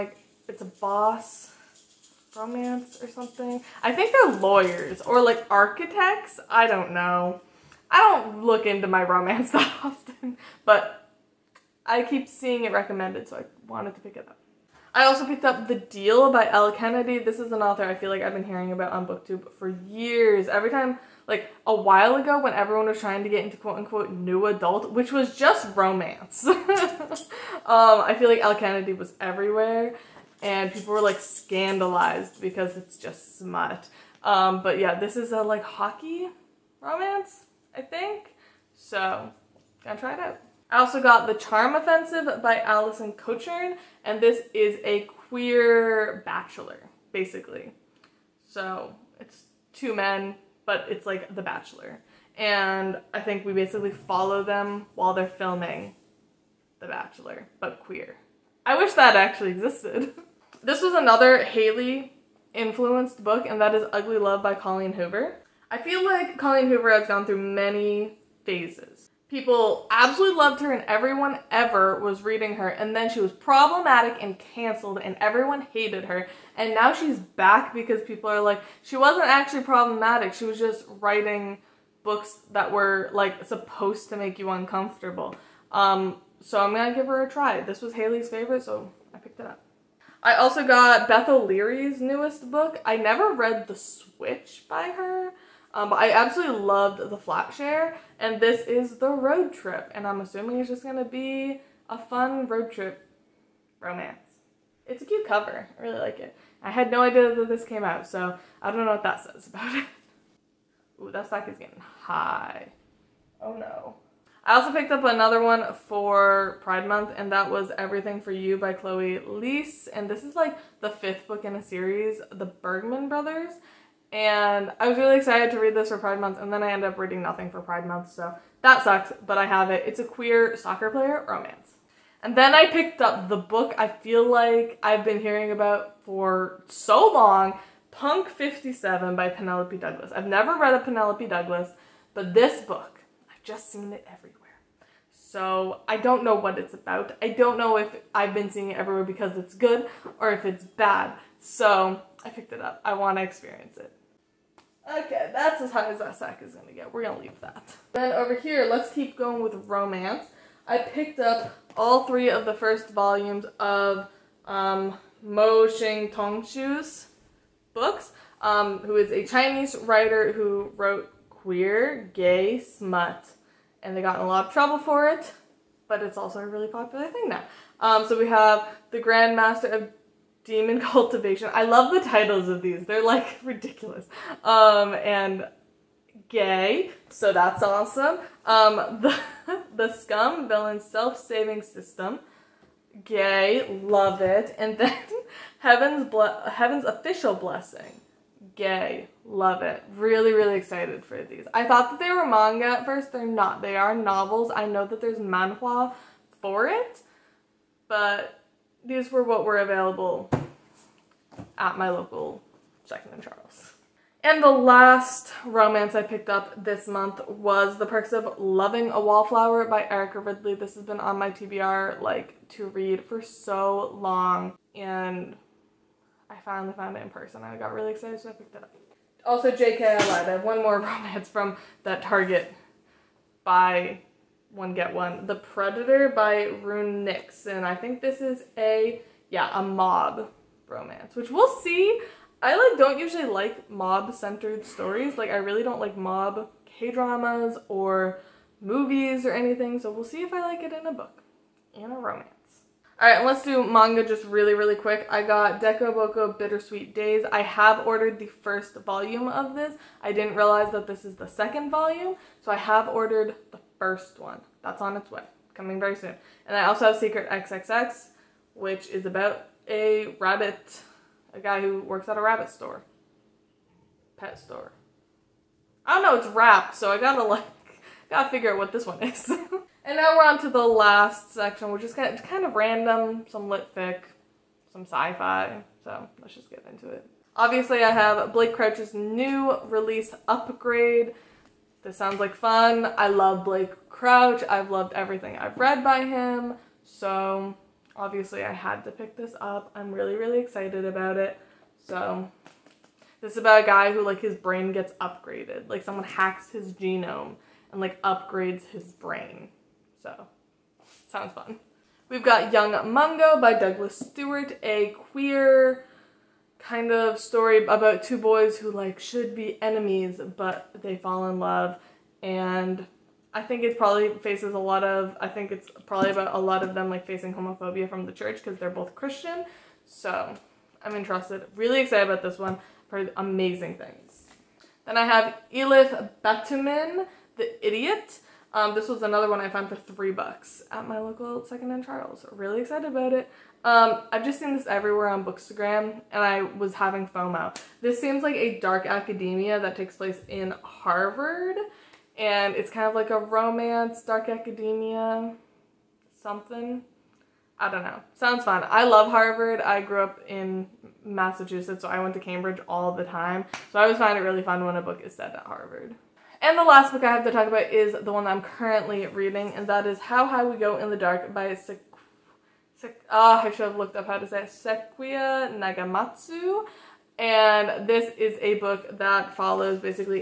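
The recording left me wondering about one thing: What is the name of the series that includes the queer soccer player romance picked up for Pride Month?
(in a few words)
The Bergman Brothers.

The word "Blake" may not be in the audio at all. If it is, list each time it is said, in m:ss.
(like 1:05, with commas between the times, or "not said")
4:48, 4:53.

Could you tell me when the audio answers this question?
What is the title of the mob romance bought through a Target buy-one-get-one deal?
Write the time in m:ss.
3:55.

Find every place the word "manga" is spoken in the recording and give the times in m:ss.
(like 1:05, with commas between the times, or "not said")
3:22, 4:13.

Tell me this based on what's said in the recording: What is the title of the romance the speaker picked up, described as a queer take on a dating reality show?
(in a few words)
The Charm Offensive.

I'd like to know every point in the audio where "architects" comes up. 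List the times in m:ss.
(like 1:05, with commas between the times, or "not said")
0:05.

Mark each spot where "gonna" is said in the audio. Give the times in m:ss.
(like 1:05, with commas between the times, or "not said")
0:39, 1:26, 1:40.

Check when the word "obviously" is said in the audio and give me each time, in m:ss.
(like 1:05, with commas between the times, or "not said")
4:47, 4:57.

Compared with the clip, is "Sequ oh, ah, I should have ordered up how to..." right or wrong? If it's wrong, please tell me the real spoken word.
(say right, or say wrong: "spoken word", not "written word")
wrong: "looked", not "ordered".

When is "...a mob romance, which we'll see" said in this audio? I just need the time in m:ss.
3:59.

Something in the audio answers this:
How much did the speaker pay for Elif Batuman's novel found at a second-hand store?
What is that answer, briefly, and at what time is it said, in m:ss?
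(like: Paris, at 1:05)
3 dollars, at 5:39.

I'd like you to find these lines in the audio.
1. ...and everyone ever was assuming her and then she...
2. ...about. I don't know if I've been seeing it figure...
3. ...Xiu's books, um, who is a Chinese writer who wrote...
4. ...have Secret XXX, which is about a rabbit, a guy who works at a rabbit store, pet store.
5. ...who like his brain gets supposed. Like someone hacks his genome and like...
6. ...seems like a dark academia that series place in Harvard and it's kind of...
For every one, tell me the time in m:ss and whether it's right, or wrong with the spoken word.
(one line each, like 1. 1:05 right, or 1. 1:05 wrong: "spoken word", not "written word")
1. 1:10 wrong: "reading", not "assuming"
2. 2:26 wrong: "everywhere", not "figure"
3. 2:46 right
4. 4:26 right
5. 5:03 wrong: "upgraded", not "supposed"
6. 5:48 wrong: "takes", not "series".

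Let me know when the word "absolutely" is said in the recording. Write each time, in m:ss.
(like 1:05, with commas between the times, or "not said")
1:09, 1:36.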